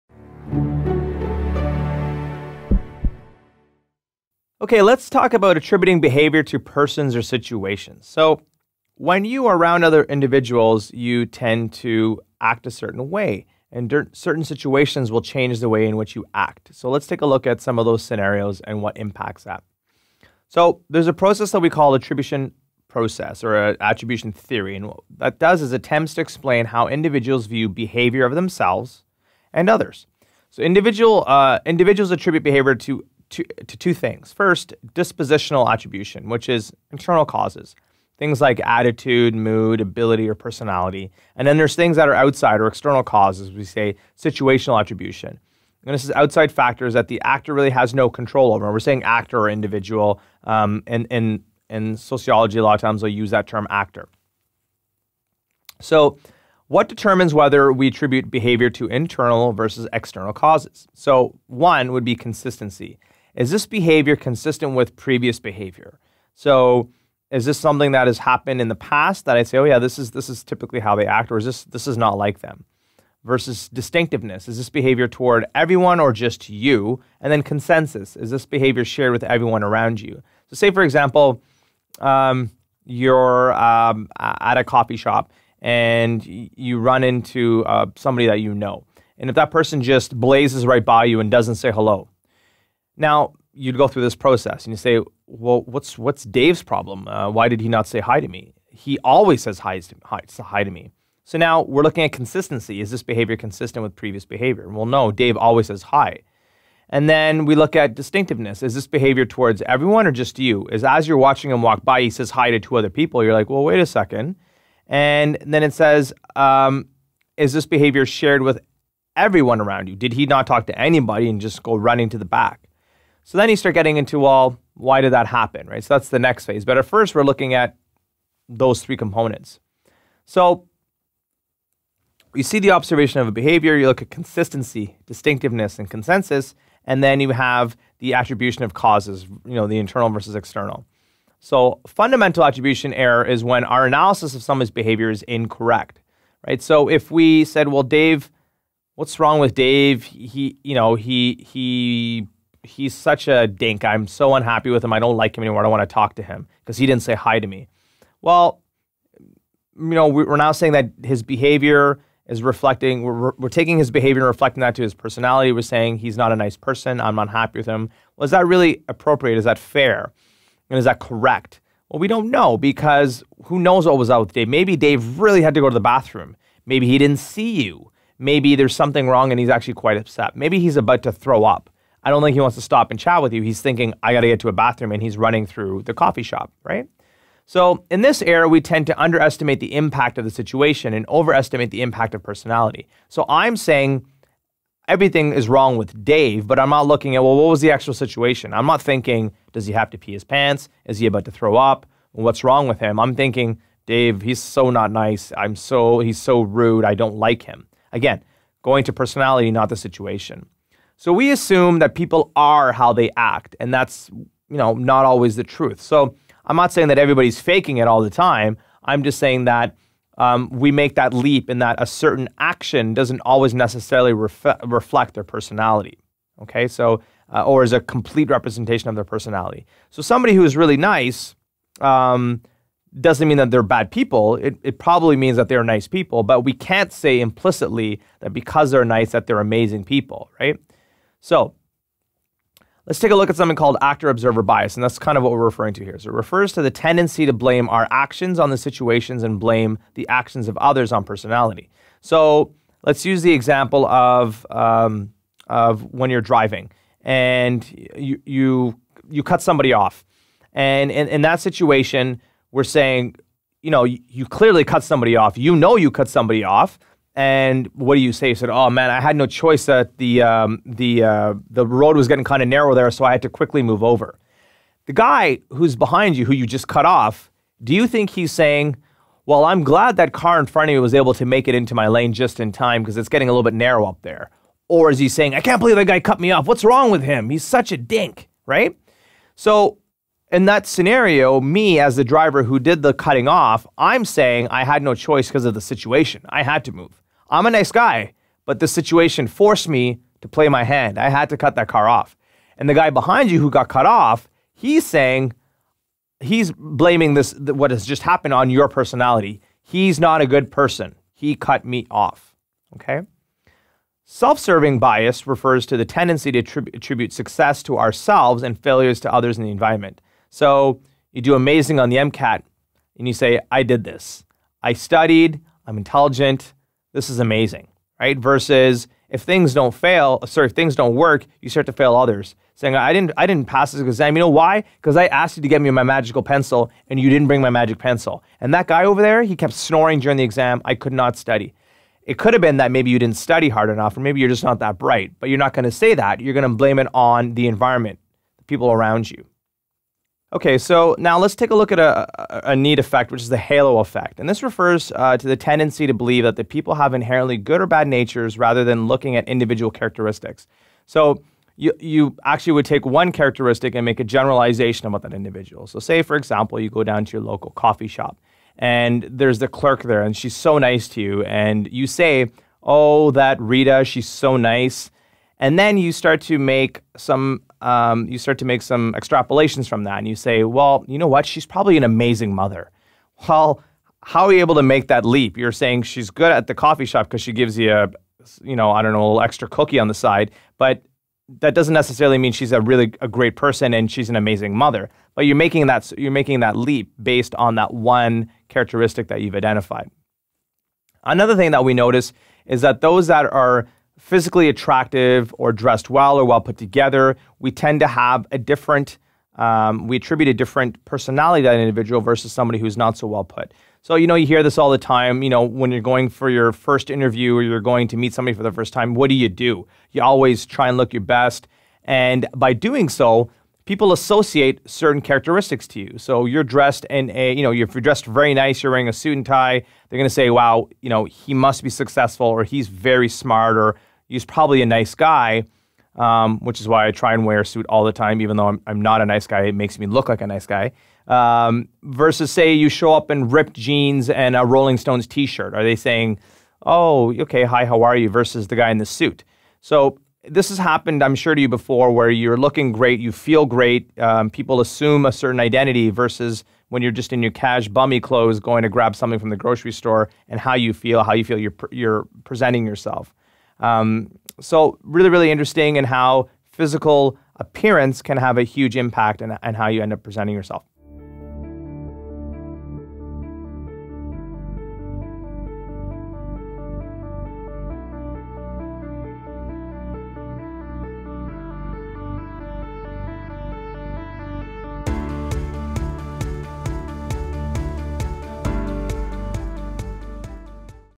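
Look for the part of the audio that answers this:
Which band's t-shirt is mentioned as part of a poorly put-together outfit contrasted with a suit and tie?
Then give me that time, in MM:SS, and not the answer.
07:24.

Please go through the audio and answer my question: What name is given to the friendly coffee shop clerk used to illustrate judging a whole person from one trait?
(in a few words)
Rita.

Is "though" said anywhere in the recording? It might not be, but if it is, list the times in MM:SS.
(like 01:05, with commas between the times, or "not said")
07:18.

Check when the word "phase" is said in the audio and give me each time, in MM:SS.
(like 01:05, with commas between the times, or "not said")
02:06.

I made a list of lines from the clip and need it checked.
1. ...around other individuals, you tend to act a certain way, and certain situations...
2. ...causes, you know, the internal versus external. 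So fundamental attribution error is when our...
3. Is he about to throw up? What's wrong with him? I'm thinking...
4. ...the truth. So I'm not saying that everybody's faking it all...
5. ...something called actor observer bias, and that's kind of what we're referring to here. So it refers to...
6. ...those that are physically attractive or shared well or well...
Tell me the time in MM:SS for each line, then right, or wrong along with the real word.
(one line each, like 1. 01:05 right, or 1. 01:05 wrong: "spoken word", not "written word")
1. 00:09 right
2. 02:18 right
3. 03:20 right
4. 03:35 right
5. 04:03 right
6. 06:42 wrong: "dressed", not "shared".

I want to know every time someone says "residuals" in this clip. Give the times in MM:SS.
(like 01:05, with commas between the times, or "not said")
not said.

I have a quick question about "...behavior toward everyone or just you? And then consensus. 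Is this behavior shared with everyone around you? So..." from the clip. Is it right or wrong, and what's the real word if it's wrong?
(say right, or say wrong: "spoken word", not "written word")
right.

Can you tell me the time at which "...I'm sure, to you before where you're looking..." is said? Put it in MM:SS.
07:31.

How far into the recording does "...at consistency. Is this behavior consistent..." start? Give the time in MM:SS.
01:42.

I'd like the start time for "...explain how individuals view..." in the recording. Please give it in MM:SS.
00:26.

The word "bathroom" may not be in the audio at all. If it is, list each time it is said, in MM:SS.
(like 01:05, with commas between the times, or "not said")
02:55, 03:04.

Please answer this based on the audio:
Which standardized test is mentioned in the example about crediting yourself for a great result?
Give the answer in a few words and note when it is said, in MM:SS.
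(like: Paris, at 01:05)
MCAT, at 05:21.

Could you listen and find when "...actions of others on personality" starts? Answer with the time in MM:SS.
04:10.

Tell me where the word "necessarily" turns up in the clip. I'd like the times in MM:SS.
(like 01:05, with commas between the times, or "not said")
03:43, 06:31.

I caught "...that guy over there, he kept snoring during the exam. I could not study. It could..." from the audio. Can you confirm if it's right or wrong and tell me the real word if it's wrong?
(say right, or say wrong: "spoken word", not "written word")
right.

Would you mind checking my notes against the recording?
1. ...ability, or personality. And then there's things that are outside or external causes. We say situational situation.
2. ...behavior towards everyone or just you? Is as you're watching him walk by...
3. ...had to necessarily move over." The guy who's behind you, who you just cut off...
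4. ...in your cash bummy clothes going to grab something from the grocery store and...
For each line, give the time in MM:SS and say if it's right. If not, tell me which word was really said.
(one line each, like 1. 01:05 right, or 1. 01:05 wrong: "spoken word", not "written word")
1. 00:39 wrong: "attribution", not "situation"
2. 01:48 right
3. 04:33 wrong: "quickly", not "necessarily"
4. 07:37 right.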